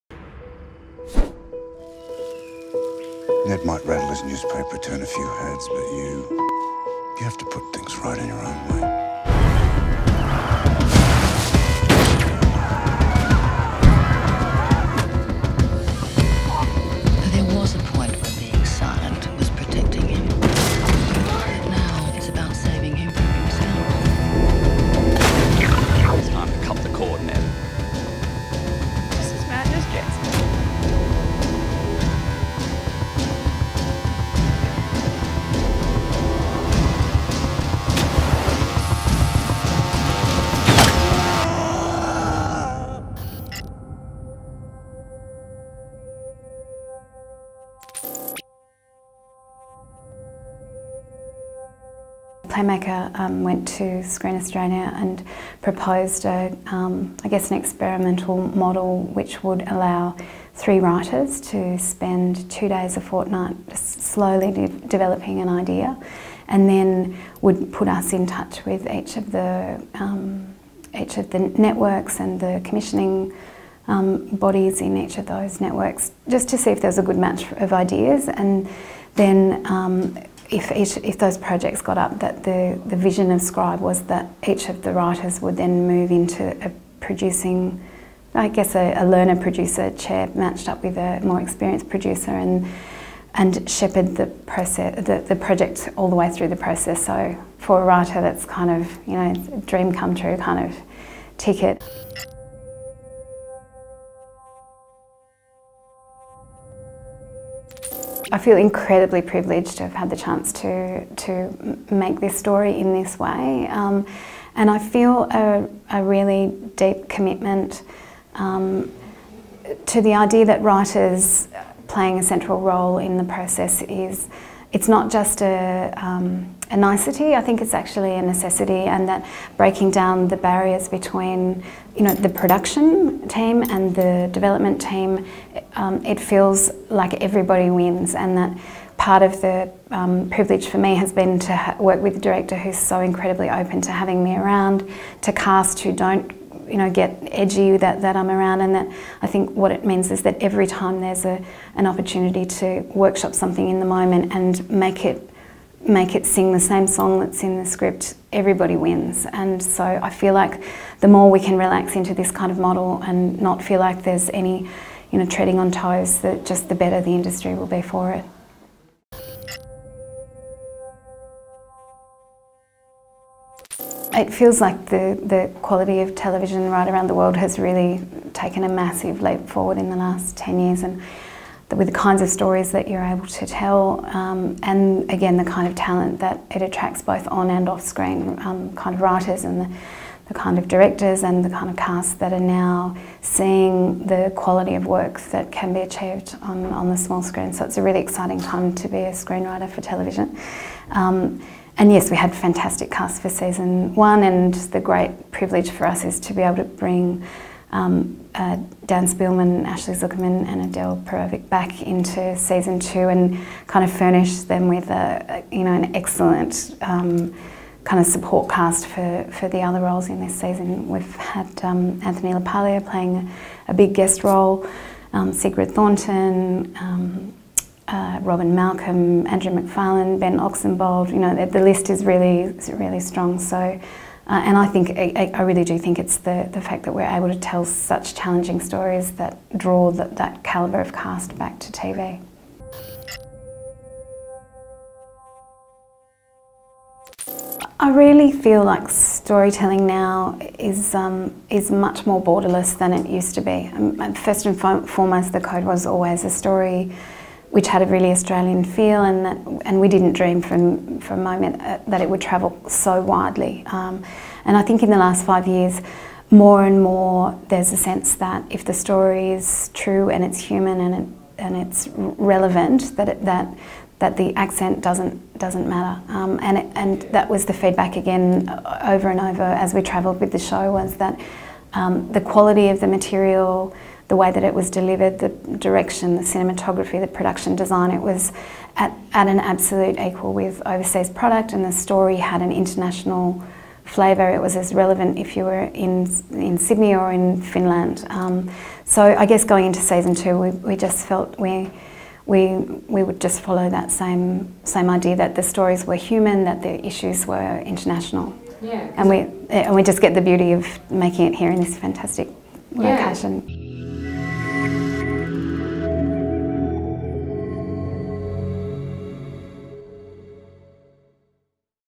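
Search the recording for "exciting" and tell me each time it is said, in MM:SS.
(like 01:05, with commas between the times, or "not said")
03:17.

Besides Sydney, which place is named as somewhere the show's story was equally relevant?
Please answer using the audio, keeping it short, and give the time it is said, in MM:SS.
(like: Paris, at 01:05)
Finland, at 04:57.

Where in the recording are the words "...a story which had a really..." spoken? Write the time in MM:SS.
04:16.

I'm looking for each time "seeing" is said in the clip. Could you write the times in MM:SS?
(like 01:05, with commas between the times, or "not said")
03:13.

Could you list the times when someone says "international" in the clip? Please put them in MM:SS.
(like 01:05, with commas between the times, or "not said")
04:52, 05:07.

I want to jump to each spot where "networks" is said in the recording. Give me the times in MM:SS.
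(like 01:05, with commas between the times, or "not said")
01:11, 01:15.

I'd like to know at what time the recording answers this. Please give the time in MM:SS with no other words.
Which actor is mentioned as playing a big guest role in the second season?
03:42.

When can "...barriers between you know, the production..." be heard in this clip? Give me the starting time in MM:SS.
02:10.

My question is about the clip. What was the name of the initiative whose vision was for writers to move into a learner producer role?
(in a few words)
Scribe.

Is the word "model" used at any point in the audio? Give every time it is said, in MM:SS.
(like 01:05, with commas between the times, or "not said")
00:58, 02:42.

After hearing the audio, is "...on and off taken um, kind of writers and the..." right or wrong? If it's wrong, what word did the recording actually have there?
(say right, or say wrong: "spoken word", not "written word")
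wrong: "screen", not "taken".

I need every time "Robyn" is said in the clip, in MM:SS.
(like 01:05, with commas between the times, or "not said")
03:48.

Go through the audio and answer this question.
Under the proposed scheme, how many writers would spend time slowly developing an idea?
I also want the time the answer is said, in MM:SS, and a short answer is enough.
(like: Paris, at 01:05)
3, at 01:00.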